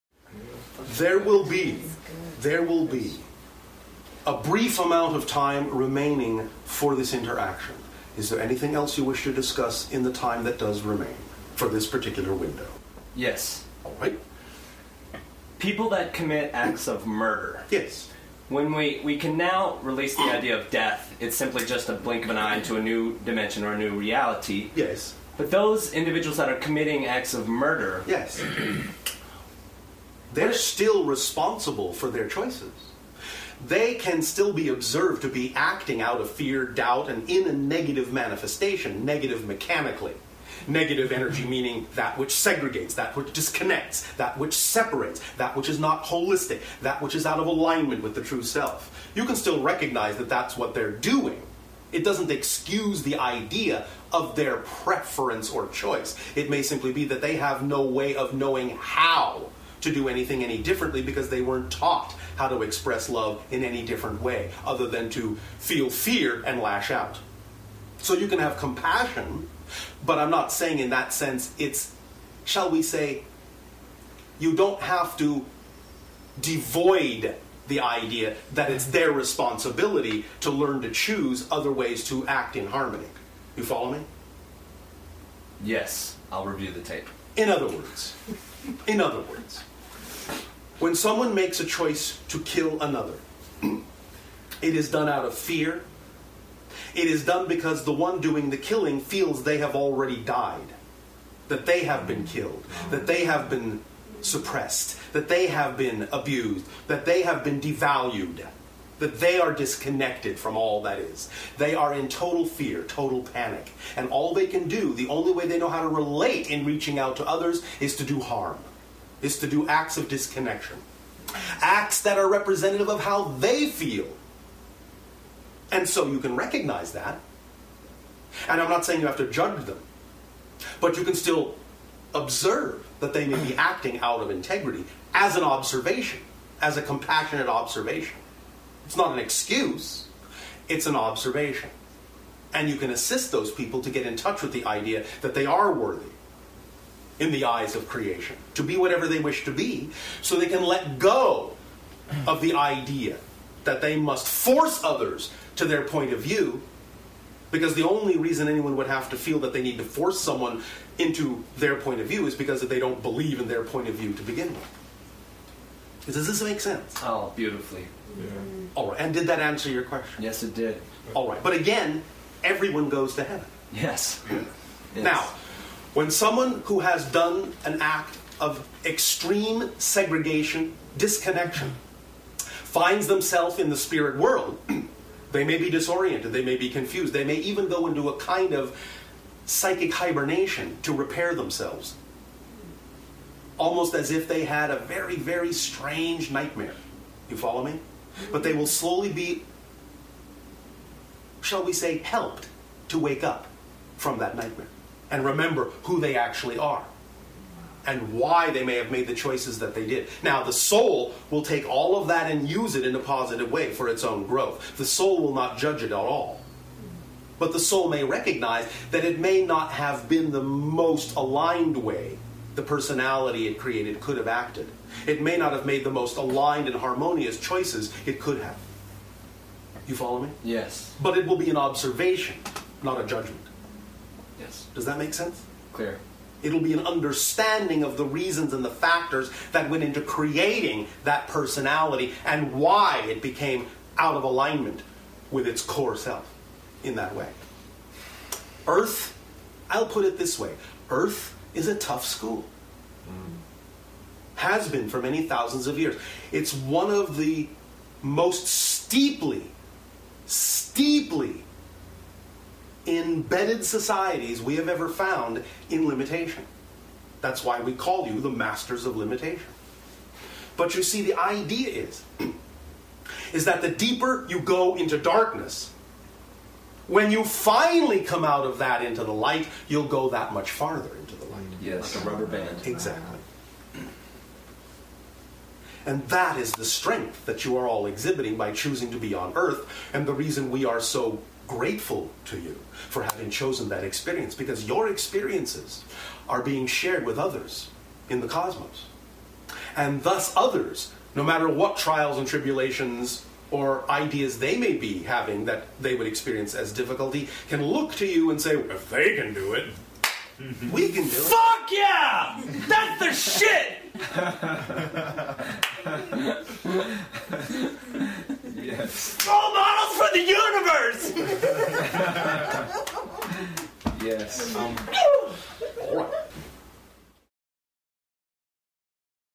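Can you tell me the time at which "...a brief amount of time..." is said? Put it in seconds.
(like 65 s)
4 s.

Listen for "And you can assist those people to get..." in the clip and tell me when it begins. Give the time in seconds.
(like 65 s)
142 s.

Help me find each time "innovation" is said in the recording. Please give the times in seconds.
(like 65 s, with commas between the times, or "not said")
not said.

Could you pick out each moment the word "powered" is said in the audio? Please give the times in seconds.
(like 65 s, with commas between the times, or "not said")
not said.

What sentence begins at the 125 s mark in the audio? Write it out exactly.
And so you can recognize that.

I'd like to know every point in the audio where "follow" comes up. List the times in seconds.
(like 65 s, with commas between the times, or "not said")
83 s, 197 s, 229 s.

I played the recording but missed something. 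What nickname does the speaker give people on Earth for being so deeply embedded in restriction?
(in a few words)
masters of limitation.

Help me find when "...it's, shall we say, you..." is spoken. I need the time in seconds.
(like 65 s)
71 s.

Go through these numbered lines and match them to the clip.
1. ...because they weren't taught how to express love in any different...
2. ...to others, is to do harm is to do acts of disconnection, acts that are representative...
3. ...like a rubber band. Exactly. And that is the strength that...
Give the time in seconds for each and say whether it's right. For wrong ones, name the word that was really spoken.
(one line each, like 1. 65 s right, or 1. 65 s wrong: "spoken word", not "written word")
1. 61 s right
2. 117 s right
3. 281 s right.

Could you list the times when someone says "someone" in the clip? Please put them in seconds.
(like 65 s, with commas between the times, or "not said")
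90 s, 160 s, 176 s.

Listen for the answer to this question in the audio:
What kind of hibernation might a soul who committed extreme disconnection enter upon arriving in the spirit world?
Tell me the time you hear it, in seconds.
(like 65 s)
189 s.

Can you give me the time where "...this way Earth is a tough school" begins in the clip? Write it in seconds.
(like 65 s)
250 s.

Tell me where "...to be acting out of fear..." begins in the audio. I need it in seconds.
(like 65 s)
35 s.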